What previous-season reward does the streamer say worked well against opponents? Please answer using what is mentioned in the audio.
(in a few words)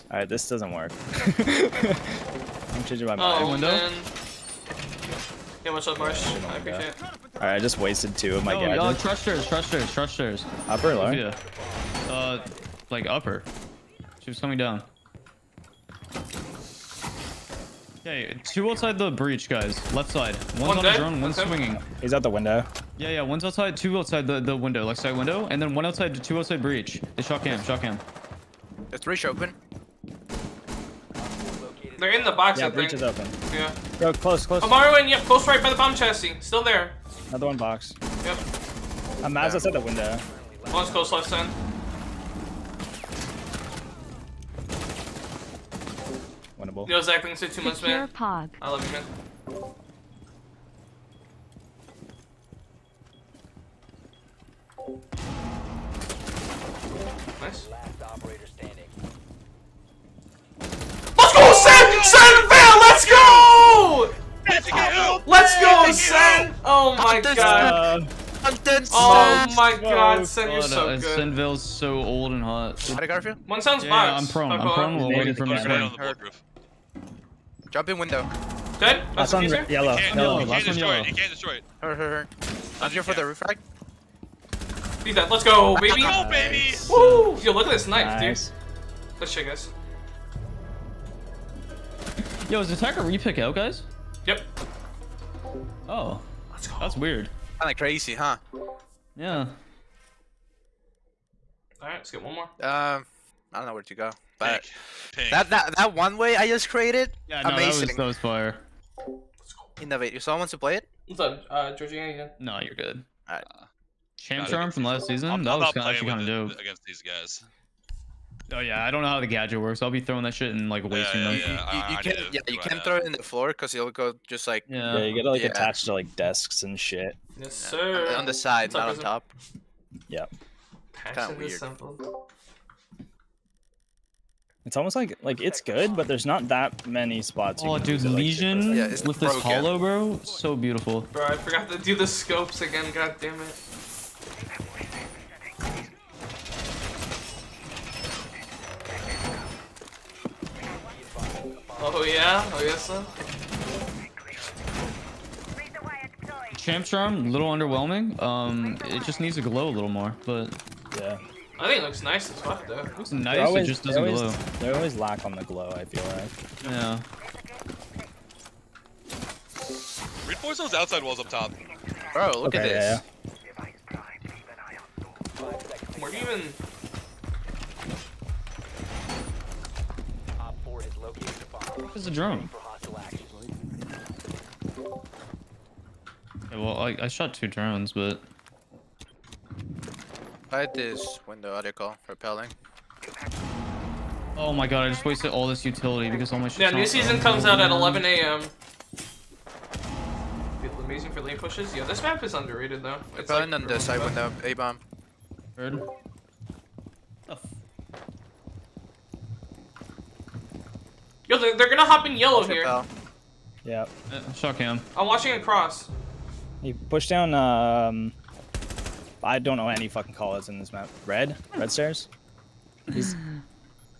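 Charm from last season.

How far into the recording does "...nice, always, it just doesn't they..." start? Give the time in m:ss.
2:43.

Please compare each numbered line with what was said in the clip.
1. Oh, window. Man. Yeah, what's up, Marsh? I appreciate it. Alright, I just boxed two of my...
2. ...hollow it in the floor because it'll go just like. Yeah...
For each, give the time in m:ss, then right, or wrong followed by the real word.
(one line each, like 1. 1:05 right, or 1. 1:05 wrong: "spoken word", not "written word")
1. 0:03 wrong: "wasted", not "boxed"
2. 2:02 wrong: "throw", not "hollow".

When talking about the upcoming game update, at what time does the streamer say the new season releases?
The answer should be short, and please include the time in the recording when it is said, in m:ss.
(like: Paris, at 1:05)
11 a.m., at 3:17.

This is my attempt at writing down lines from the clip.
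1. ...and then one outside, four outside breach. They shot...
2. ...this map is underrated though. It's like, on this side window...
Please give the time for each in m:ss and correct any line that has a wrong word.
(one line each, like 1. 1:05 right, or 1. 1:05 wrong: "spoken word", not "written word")
1. 0:25 wrong: "two", not "four"
2. 3:21 right.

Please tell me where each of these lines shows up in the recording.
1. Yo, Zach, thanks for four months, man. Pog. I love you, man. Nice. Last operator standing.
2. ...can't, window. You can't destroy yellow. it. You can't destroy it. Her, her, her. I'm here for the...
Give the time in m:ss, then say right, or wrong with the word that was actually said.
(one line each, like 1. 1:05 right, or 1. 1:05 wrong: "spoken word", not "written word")
1. 0:46 wrong: "two", not "four"
2. 1:20 wrong: "yellow", not "window".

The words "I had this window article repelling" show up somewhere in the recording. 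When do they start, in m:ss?
3:10.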